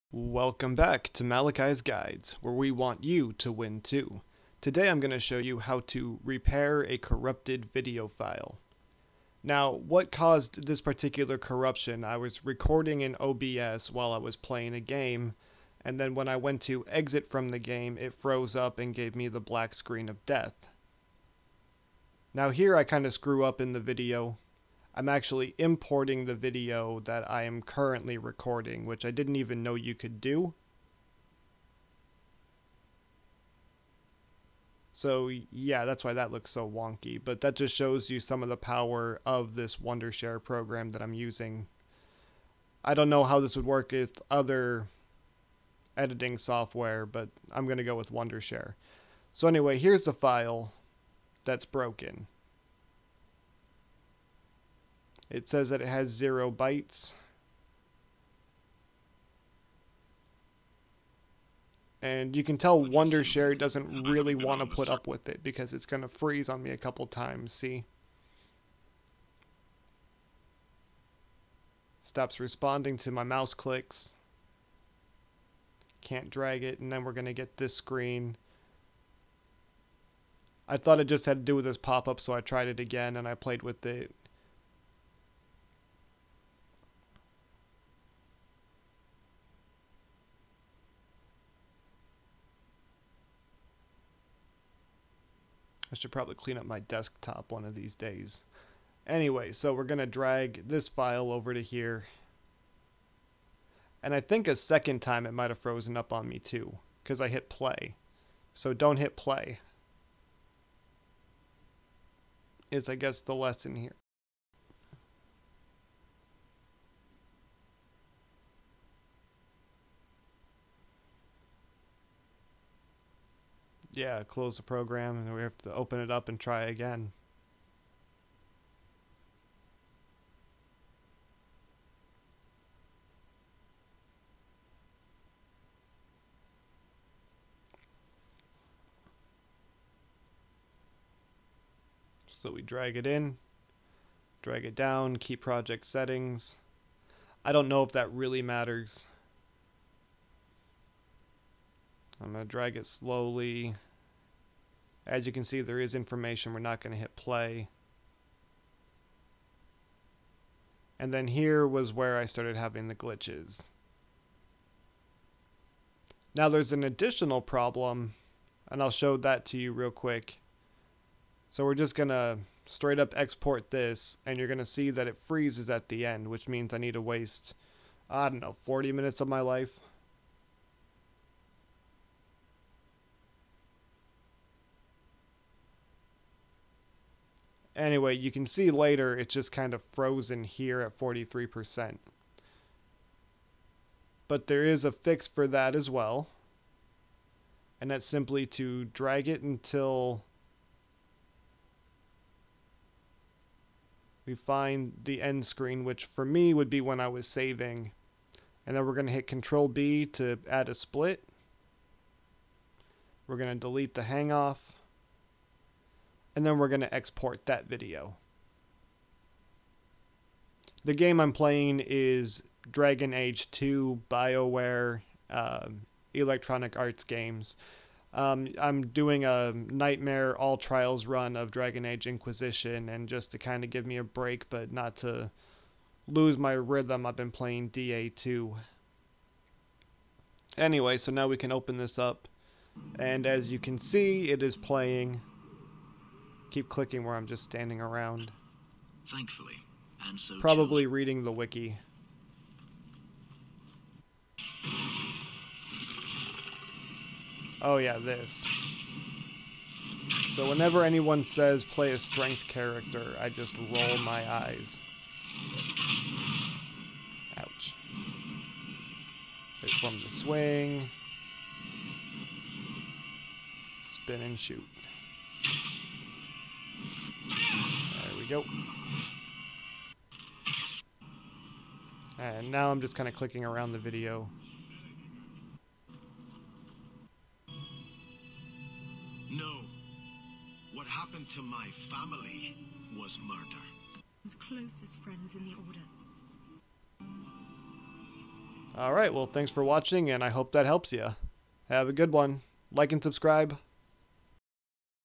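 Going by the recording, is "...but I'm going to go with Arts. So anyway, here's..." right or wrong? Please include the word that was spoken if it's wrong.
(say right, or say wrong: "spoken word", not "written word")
wrong: "Wondershare", not "Arts".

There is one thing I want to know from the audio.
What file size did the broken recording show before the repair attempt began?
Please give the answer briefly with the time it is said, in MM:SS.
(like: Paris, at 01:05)
zero bytes, at 00:56.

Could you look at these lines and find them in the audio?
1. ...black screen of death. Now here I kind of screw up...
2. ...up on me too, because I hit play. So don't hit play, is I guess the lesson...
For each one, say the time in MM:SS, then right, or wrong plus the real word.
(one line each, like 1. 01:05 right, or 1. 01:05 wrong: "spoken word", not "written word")
1. 00:19 right
2. 01:45 right.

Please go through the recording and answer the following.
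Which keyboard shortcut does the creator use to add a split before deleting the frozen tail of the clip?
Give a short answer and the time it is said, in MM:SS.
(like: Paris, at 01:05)
Control B, at 03:29.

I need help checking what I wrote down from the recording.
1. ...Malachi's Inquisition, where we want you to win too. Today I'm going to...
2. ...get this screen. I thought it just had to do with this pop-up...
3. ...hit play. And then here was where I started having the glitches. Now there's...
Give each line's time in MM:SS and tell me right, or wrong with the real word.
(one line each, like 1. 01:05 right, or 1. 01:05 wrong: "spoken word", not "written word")
1. 00:01 wrong: "Guides", not "Inquisition"
2. 01:17 right
3. 02:36 right.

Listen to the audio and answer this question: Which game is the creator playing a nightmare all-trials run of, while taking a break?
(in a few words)
Dragon Age Inquisition.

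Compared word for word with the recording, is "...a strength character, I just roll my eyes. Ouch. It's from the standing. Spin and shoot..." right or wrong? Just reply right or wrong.
wrong.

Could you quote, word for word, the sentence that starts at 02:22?
So we drag it in, drag it down, keep project settings.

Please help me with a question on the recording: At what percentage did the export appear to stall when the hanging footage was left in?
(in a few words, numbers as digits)
43%.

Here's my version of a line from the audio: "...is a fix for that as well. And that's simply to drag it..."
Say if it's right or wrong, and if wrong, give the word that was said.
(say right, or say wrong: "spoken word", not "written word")
right.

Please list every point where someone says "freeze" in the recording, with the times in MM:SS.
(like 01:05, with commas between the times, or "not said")
01:06, 02:55.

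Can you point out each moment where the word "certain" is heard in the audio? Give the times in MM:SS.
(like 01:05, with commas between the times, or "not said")
not said.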